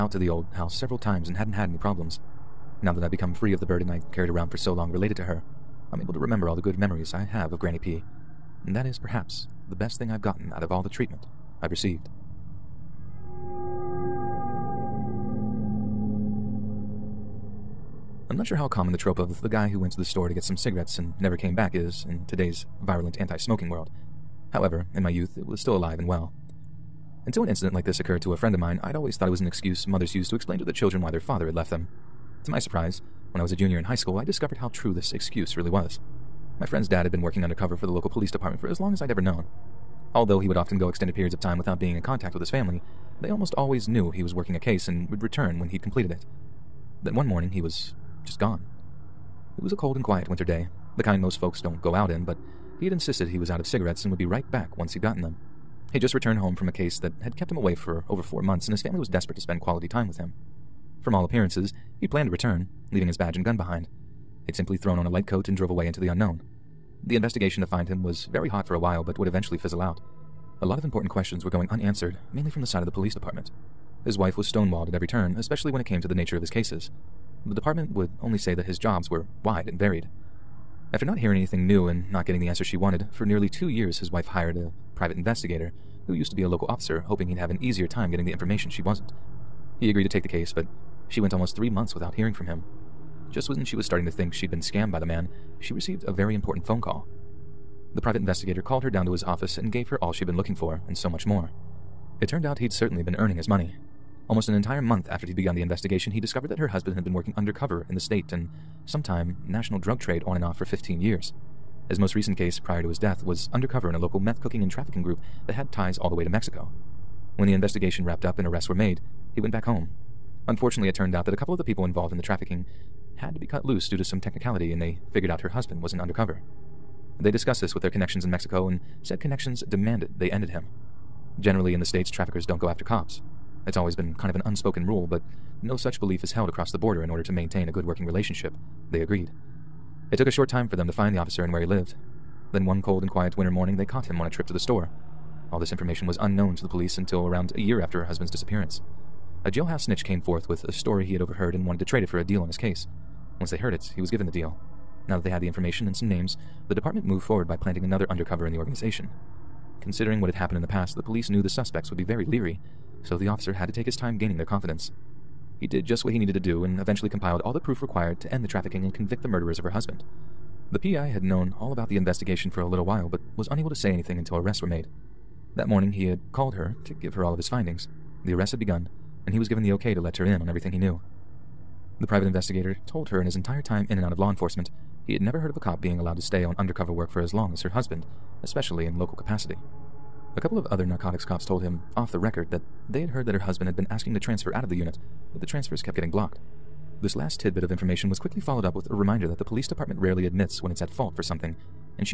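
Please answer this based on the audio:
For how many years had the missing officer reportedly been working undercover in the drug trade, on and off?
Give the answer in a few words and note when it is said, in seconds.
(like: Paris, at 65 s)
15, at 110 s.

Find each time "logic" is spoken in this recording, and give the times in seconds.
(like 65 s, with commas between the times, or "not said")
not said.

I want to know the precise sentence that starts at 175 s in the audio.
That morning he had called her to give her all of his findings.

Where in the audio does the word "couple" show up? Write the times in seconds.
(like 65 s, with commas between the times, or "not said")
121 s, 190 s.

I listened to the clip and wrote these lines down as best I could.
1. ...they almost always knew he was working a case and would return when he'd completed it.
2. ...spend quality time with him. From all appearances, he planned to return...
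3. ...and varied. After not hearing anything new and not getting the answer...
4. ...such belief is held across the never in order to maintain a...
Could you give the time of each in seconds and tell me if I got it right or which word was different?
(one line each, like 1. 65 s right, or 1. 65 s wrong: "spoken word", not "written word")
1. 43 s right
2. 59 s right
3. 79 s right
4. 135 s wrong: "border", not "never".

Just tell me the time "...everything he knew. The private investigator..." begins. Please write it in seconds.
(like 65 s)
180 s.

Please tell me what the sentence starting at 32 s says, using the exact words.
To my surprise, when I was a junior in high school, I discovered how true this excuse really was.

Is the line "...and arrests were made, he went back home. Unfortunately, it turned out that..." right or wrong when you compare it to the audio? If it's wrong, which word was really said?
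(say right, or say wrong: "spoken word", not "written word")
right.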